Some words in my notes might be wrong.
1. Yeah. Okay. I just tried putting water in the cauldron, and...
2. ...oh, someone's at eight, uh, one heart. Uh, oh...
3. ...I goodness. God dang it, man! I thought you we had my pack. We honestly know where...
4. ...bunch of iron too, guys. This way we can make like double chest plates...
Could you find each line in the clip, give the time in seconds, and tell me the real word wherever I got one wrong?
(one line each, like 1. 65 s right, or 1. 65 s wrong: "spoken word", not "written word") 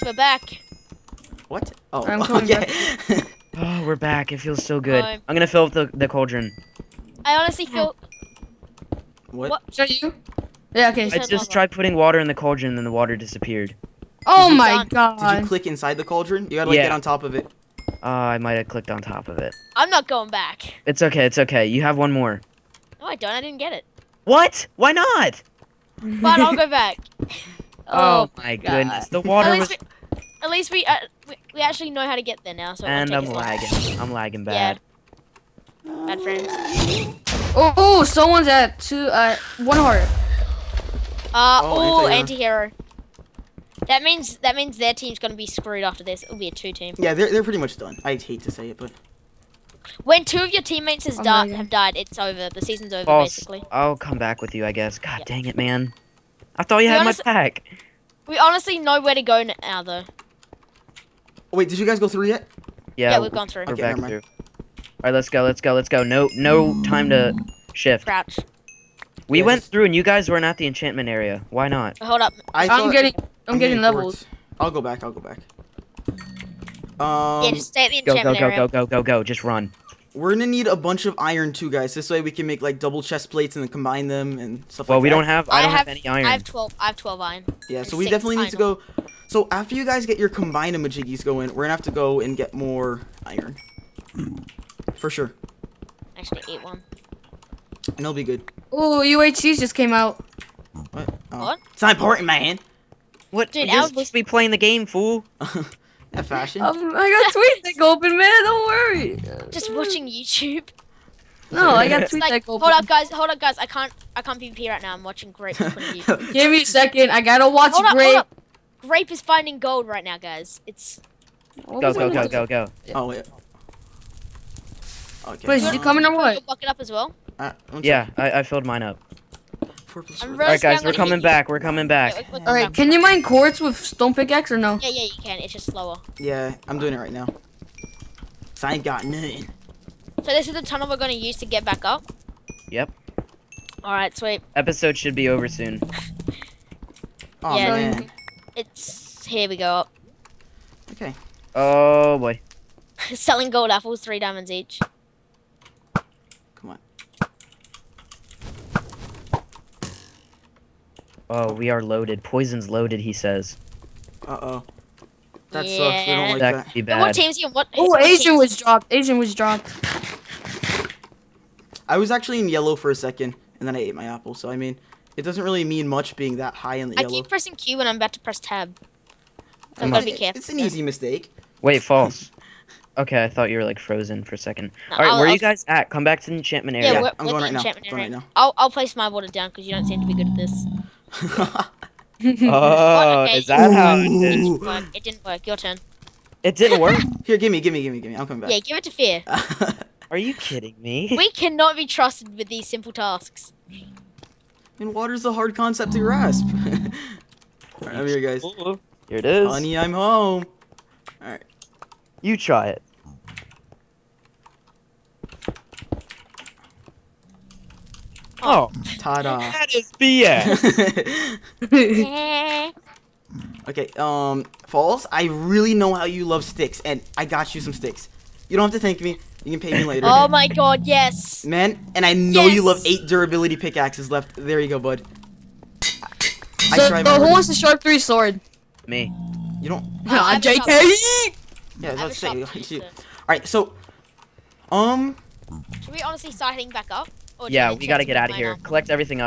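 1. 10 s right
2. 37 s wrong: "two", not "eight"
3. 54 s wrong: "guess", not "goodness"
4. 80 s right.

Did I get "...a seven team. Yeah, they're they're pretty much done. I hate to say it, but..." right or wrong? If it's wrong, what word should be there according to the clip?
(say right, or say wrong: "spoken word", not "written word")
wrong: "two", not "seven".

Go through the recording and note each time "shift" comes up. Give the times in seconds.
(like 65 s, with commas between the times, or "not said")
67 s.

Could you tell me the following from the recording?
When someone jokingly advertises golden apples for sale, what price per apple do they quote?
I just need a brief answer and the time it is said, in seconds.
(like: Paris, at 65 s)
3 diamonds, at 154 s.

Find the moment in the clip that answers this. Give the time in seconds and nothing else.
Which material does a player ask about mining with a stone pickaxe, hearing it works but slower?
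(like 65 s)
133 s.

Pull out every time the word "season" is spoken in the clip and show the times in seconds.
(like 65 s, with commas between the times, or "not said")
52 s.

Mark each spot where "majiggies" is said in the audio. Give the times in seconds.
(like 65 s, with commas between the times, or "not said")
90 s.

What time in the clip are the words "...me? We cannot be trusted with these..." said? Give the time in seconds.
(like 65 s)
200 s.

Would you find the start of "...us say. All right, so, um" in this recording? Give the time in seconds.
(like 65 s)
242 s.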